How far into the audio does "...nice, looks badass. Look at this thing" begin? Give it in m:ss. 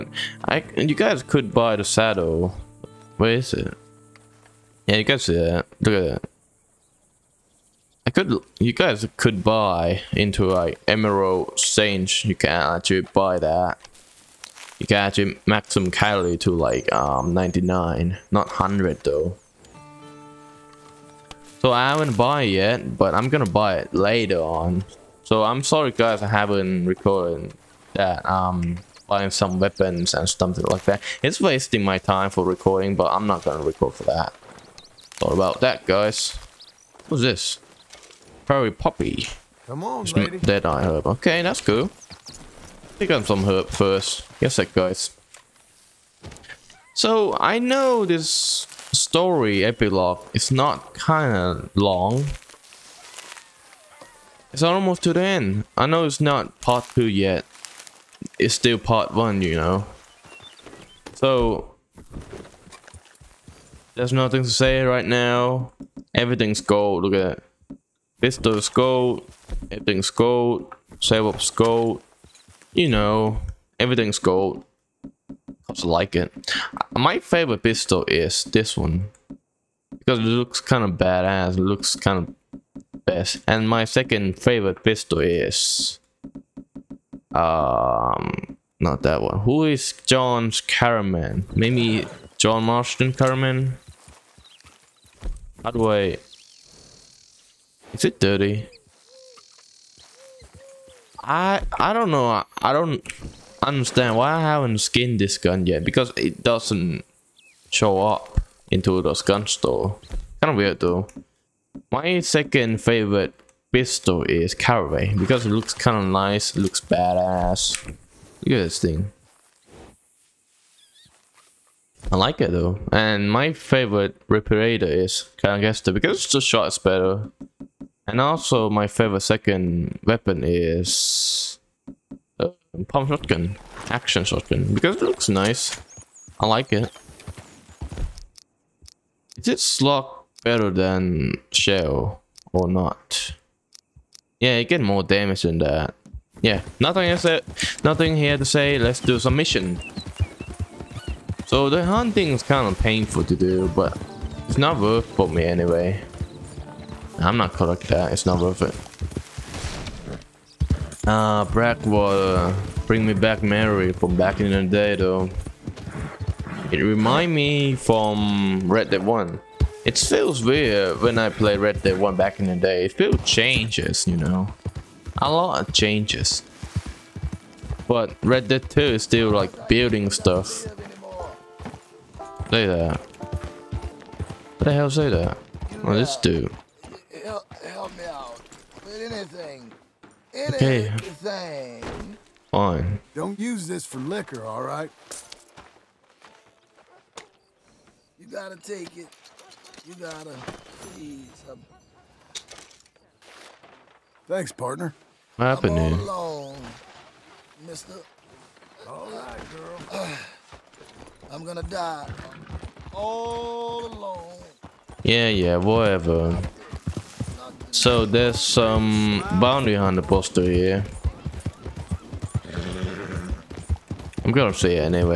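1:56.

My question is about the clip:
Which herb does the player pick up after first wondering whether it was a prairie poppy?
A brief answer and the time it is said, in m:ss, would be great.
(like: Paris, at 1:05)
Dead eye herb, at 0:40.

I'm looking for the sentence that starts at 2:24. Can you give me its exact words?
Yeah, you get more damage than that.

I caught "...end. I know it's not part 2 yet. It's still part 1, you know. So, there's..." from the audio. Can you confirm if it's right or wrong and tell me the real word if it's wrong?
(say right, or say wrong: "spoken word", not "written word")
right.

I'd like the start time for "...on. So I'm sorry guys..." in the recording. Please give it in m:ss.
0:24.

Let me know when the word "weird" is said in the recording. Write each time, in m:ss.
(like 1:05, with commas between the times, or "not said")
1:50, 2:50.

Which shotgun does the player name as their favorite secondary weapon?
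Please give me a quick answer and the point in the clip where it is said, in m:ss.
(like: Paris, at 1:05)
Pump shotgun, at 2:12.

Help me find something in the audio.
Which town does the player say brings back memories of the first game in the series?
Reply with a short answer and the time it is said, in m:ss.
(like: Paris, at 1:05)
Blackwater, at 2:41.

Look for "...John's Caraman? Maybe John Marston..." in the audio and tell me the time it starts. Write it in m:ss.
1:30.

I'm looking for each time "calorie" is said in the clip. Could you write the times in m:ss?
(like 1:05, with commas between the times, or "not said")
0:15.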